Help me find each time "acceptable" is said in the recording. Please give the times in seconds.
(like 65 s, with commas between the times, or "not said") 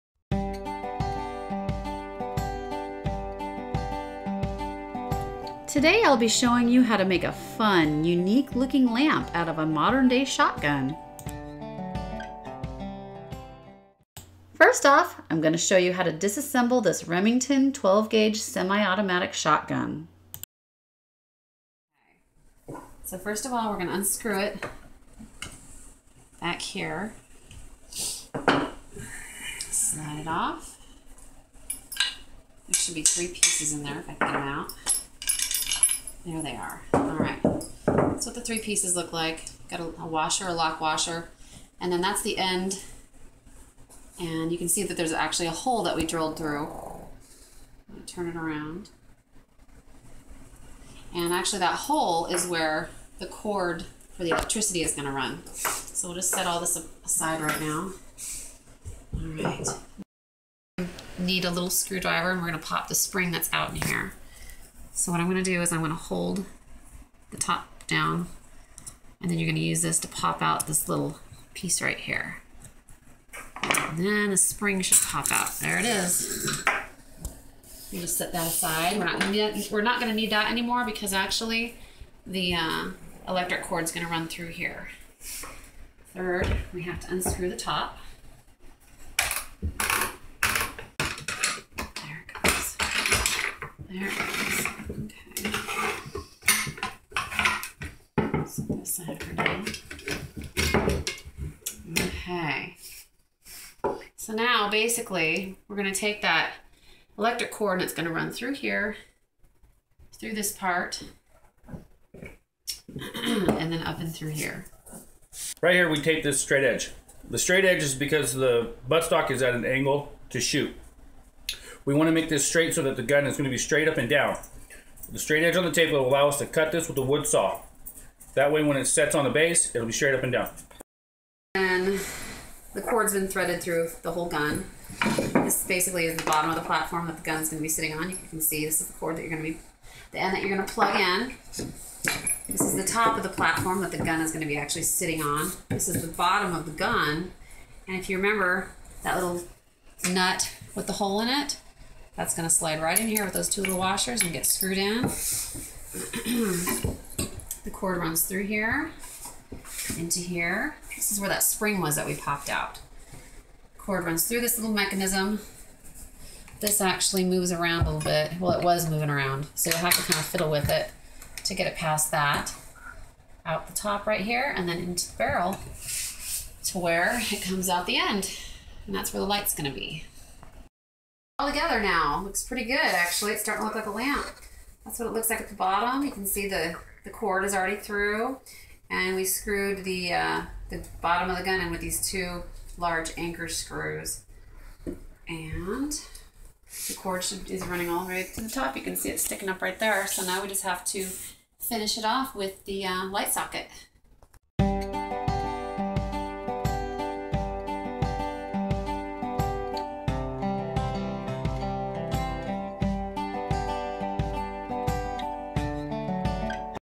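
not said.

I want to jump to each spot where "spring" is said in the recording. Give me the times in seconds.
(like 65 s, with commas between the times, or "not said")
62 s, 74 s, 161 s.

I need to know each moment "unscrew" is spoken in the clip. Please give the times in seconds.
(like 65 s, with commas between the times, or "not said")
23 s, 87 s.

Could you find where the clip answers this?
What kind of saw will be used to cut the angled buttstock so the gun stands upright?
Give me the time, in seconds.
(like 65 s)
127 s.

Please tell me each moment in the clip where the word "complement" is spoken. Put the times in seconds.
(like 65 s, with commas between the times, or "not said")
not said.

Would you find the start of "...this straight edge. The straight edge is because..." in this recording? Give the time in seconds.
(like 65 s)
116 s.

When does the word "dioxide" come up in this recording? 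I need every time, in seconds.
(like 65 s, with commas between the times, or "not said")
not said.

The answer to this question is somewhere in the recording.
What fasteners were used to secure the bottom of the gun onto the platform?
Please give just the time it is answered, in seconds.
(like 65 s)
192 s.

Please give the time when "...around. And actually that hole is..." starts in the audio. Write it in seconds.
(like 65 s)
48 s.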